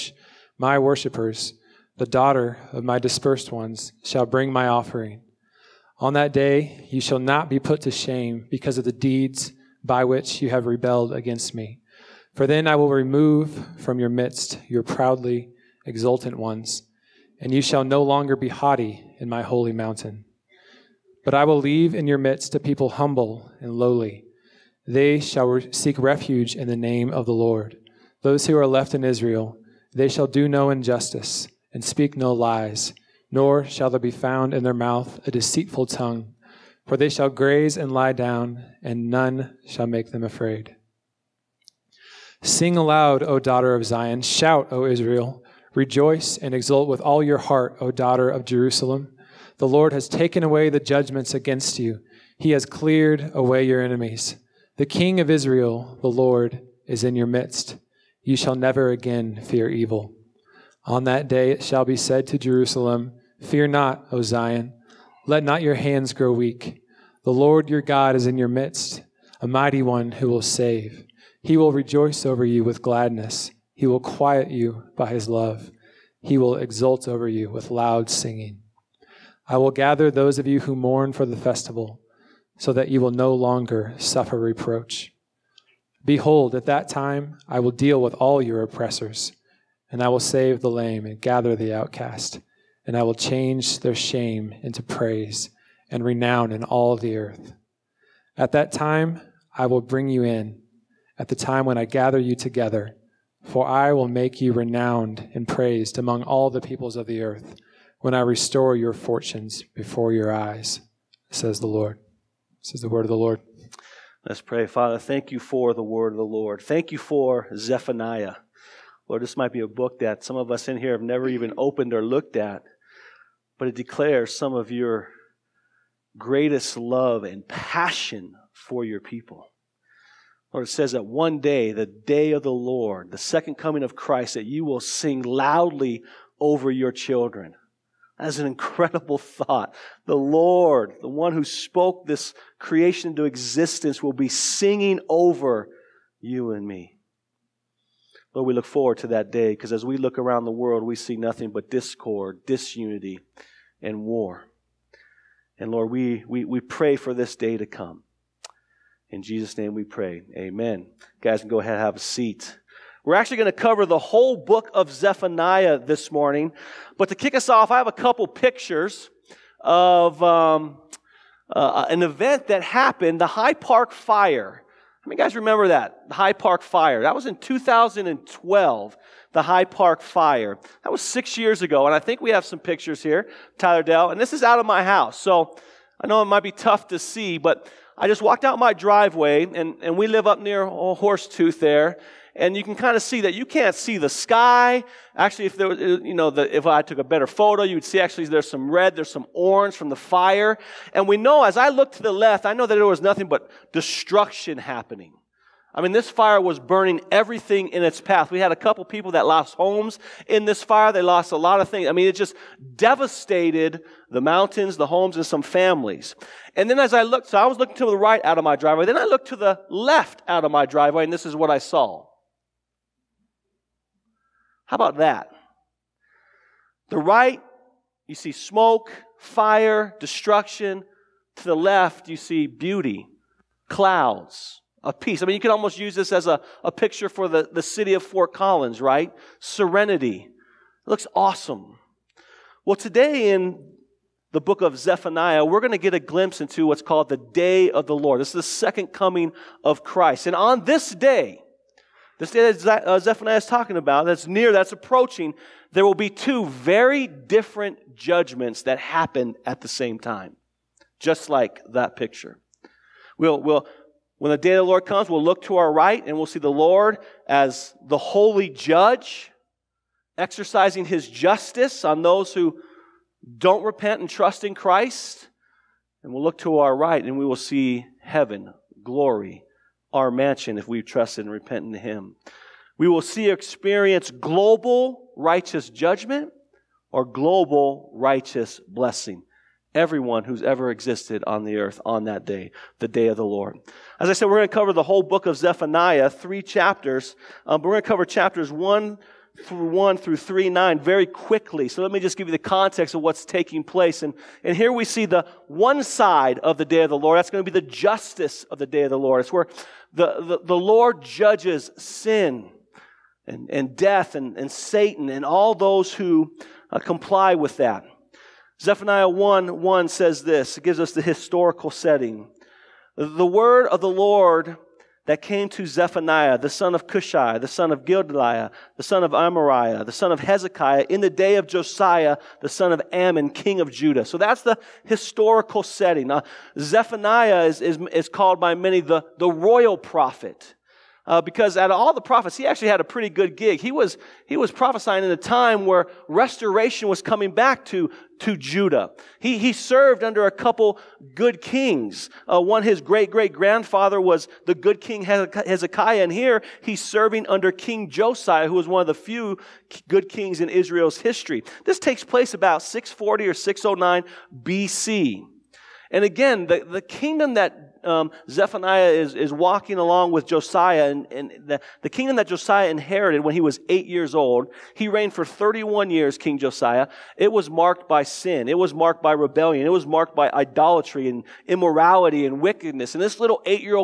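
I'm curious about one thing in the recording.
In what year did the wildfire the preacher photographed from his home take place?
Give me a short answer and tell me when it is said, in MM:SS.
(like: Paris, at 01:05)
2012, at 02:57.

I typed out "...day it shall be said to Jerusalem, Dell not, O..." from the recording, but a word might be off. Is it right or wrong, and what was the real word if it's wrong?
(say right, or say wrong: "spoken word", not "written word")
wrong: "Fear", not "Dell".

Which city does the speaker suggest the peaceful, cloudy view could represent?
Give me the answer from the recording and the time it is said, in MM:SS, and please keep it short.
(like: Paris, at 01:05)
Fort Collins, at 03:58.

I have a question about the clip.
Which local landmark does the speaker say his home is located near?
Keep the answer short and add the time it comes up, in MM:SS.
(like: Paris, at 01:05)
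Horsetooth, at 03:10.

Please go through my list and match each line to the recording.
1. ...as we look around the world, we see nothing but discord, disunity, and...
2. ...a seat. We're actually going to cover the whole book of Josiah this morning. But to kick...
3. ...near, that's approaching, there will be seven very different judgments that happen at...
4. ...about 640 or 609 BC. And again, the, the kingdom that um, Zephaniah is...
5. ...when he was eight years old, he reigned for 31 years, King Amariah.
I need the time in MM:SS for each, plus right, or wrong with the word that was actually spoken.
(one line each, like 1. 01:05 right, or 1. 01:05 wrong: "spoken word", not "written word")
1. 02:29 right
2. 02:41 wrong: "Zephaniah", not "Josiah"
3. 04:14 wrong: "two", not "seven"
4. 06:02 right
5. 06:13 wrong: "Josiah", not "Amariah".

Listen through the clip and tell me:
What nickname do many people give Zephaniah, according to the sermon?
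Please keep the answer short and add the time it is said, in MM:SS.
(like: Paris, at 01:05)
the royal prophet, at 05:39.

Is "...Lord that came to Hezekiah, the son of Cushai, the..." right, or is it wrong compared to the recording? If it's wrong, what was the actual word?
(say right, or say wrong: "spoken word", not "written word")
wrong: "Zephaniah", not "Hezekiah".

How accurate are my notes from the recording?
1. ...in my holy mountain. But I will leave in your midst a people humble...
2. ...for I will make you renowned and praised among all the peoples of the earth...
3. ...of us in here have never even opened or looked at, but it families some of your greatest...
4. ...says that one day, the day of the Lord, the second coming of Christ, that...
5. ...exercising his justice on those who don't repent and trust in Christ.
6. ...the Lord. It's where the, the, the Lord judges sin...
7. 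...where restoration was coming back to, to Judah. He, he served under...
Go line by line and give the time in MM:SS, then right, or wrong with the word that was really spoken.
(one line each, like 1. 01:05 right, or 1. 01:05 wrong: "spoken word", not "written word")
1. 00:19 right
2. 01:43 right
3. 02:00 wrong: "declares", not "families"
4. 02:10 right
5. 04:30 right
6. 05:08 right
7. 05:45 right.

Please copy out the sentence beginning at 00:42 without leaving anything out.
Sing aloud, O daughter of Zion.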